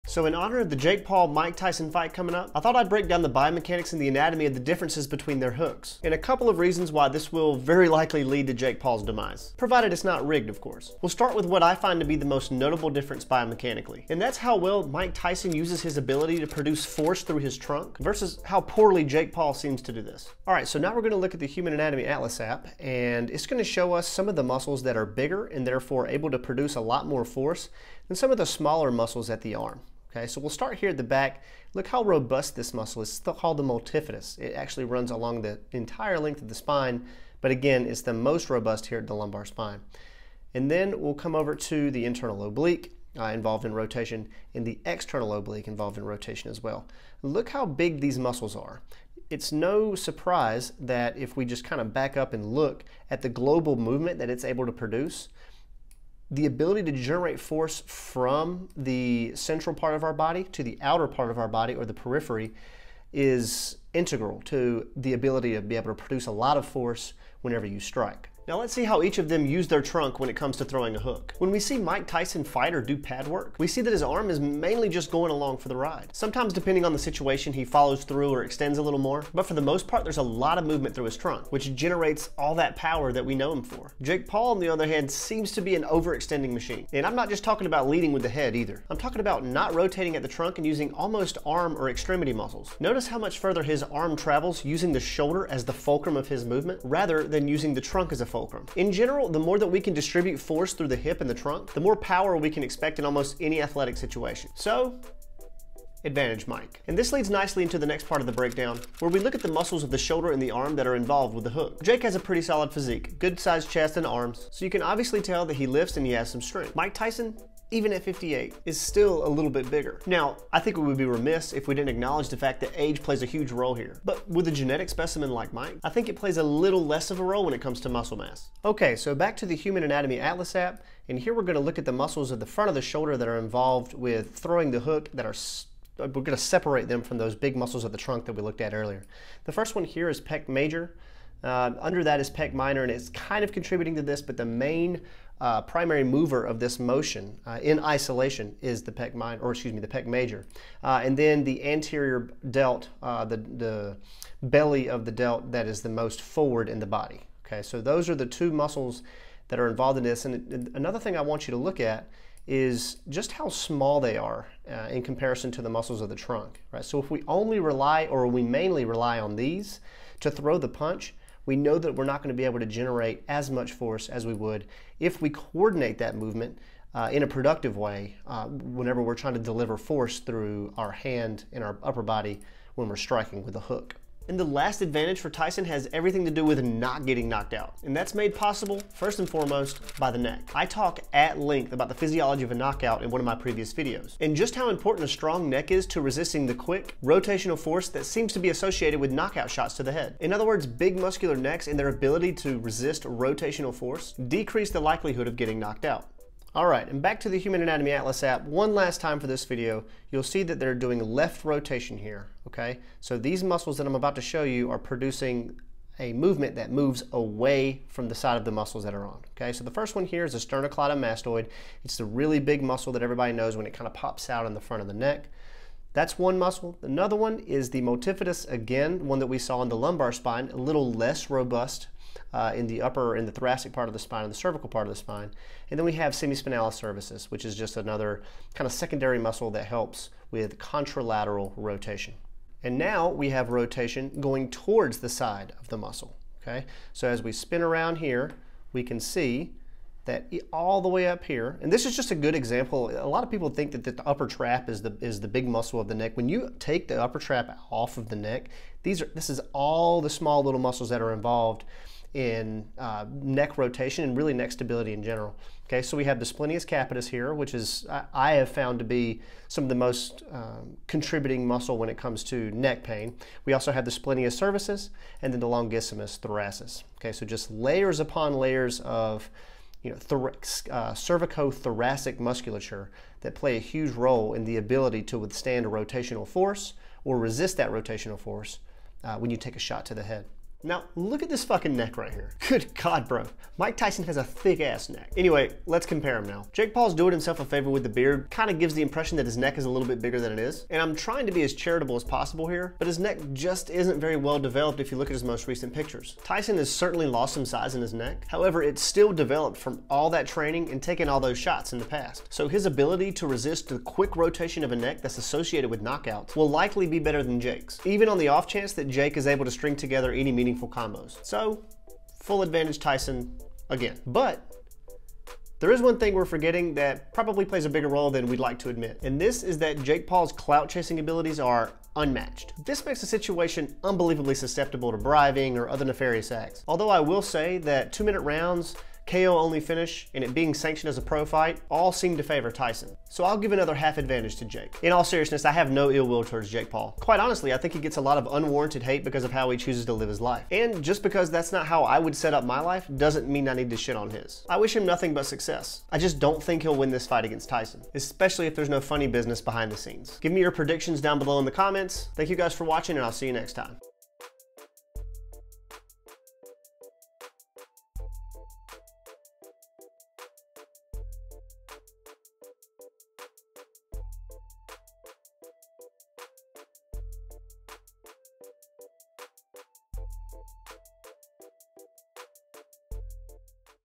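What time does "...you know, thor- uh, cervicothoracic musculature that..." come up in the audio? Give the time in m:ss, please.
4:39.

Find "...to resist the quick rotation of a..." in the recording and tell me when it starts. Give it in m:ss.
5:13.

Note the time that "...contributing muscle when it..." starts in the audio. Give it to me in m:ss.
4:30.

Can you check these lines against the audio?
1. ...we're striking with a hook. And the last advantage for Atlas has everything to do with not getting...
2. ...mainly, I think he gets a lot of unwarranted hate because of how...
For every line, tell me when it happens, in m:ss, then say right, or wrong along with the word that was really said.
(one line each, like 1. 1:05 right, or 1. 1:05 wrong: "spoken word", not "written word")
1. 3:02 wrong: "Tyson", not "Atlas"
2. 5:47 wrong: "honestly", not "mainly".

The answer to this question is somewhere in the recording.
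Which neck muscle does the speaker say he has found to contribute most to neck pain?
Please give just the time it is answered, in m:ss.
4:26.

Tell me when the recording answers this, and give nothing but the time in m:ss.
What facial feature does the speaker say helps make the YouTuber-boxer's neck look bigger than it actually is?
4:57.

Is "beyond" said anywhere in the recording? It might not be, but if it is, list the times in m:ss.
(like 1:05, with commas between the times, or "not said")
not said.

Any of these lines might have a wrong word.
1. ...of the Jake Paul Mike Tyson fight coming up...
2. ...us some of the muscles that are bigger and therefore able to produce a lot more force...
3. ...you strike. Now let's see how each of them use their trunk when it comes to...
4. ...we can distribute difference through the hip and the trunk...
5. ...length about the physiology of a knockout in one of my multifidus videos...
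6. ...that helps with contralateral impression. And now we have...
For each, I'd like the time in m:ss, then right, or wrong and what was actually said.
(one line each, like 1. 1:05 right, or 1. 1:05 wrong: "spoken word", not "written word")
1. 0:00 right
2. 0:23 right
3. 1:07 right
4. 1:39 wrong: "force", not "difference"
5. 3:11 wrong: "previous", not "multifidus"
6. 3:59 wrong: "rotation", not "impression".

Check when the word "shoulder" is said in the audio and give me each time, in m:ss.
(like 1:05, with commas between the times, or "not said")
1:34, 1:49, 2:12.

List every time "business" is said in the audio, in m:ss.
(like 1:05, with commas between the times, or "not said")
5:59.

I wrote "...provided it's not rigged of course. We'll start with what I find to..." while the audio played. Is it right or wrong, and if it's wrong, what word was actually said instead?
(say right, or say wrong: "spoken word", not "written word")
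right.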